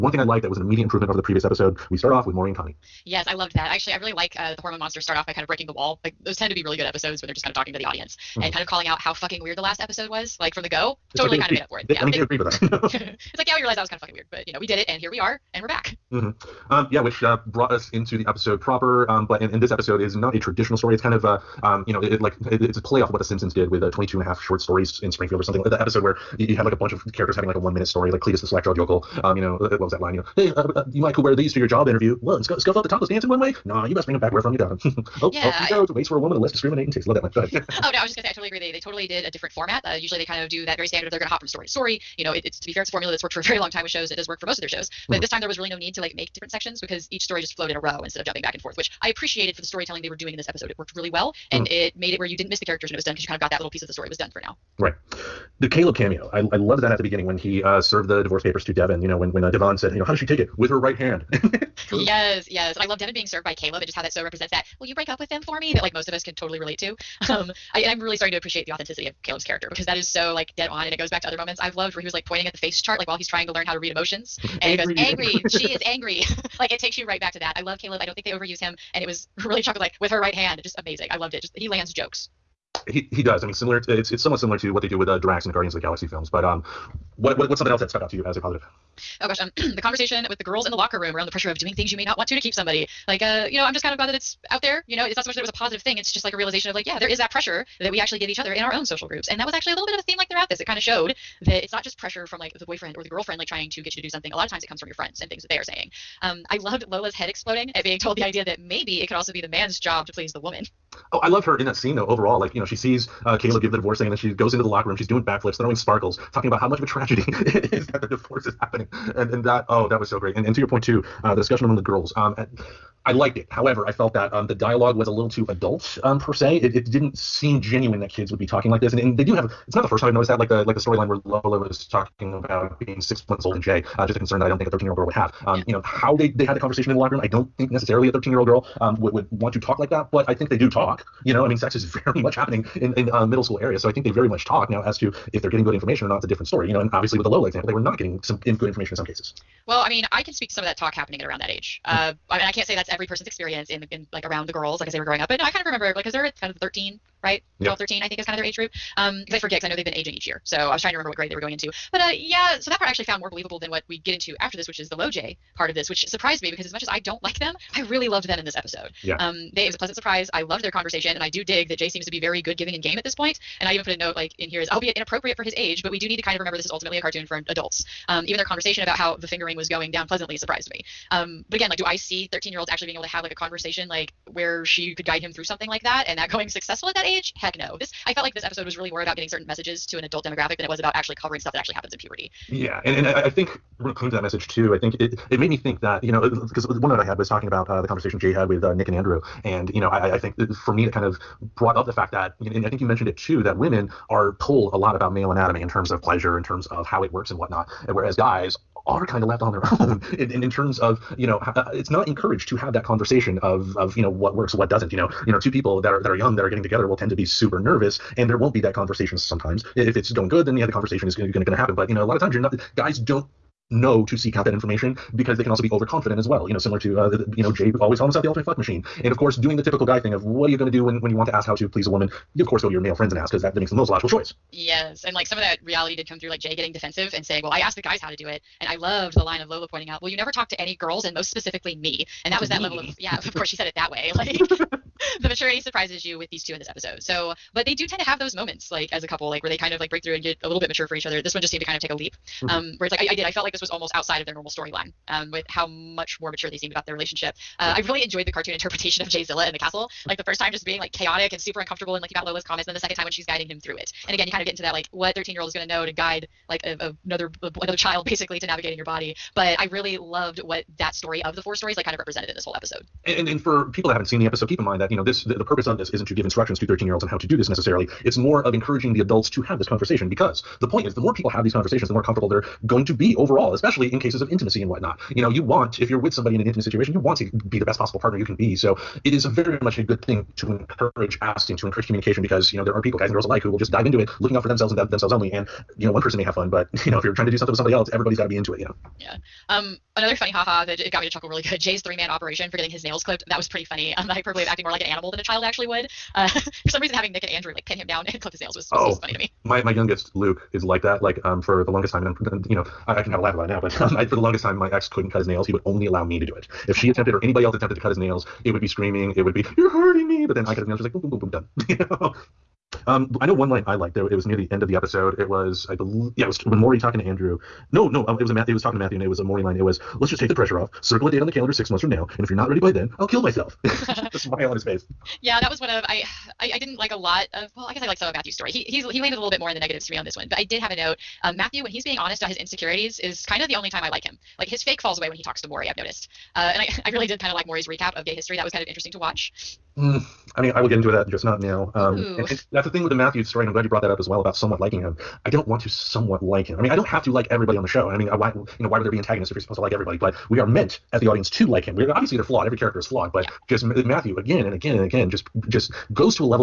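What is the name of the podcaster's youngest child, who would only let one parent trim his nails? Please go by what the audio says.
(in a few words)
Luke.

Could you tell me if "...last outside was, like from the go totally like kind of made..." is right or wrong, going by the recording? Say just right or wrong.
wrong.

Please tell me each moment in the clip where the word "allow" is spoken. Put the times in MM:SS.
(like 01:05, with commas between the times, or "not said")
05:15.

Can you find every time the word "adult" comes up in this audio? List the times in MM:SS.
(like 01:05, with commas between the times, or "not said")
02:05, 02:57, 03:10, 04:39.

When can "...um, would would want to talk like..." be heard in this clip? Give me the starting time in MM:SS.
02:18.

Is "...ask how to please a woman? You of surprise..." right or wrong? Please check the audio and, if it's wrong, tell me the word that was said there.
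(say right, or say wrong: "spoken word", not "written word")
wrong: "course", not "surprise".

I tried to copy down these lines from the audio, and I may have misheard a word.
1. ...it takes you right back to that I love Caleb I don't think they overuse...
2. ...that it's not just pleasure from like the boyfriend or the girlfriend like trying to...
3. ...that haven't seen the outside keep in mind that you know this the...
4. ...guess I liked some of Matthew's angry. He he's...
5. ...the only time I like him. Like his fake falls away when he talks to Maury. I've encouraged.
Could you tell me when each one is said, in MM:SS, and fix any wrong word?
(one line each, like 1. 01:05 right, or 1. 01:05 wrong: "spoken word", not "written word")
1. 01:16 right
2. 01:41 wrong: "pressure", not "pleasure"
3. 04:33 wrong: "episode", not "outside"
4. 05:37 wrong: "story", not "angry"
5. 05:43 wrong: "noticed", not "encouraged".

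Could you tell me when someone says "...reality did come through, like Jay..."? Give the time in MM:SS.
03:55.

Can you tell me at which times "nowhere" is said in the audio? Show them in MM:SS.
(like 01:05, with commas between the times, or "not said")
not said.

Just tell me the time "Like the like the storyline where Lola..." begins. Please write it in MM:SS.
02:10.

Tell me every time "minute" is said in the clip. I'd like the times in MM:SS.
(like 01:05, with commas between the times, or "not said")
00:27.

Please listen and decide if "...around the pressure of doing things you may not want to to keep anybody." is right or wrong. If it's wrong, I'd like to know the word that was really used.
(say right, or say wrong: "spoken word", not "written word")
wrong: "somebody", not "anybody".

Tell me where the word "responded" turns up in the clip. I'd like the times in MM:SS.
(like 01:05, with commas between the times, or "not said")
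not said.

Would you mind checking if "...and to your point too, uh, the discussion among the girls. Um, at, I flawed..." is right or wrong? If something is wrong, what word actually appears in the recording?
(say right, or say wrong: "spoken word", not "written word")
wrong: "liked", not "flawed".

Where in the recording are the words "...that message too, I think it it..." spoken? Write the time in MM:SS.
03:14.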